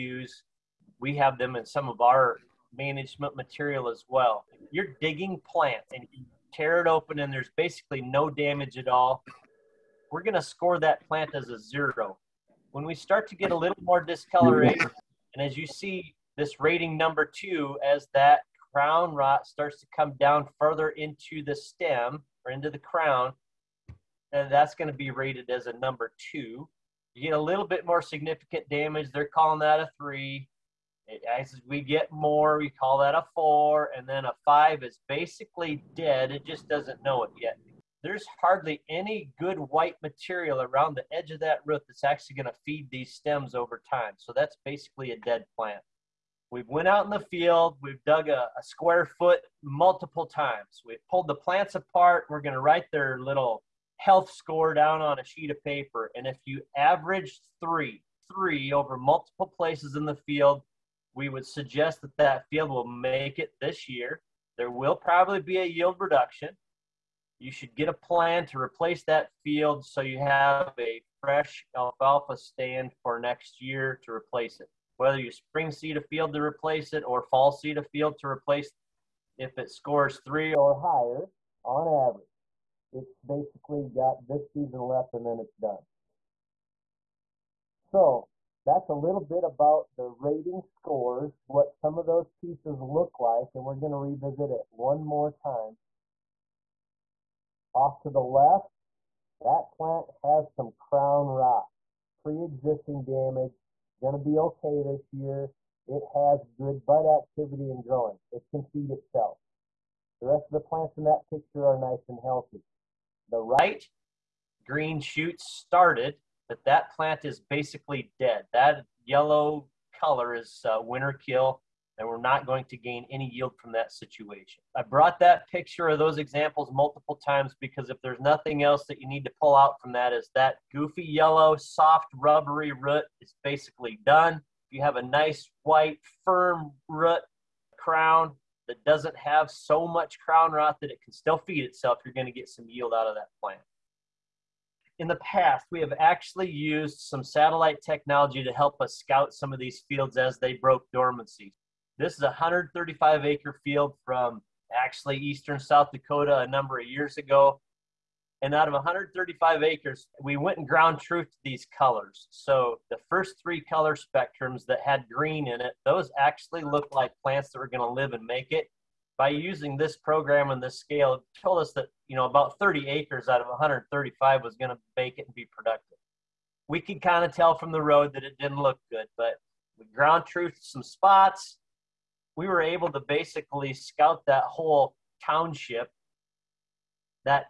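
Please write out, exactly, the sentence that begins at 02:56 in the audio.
We could kind of tell from the road that it didn't look good, but we ground truthed some spots.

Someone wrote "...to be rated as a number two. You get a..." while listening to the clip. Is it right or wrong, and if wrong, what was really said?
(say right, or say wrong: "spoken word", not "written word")
right.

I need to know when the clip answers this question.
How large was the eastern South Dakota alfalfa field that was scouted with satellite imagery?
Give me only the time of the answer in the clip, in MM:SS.
02:32.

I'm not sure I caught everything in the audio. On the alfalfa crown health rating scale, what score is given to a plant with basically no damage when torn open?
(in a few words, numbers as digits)
0.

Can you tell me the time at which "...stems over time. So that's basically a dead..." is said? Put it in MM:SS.
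00:43.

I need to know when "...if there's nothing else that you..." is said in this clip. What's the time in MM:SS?
02:07.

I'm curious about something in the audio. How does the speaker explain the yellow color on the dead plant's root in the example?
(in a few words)
Winter kill.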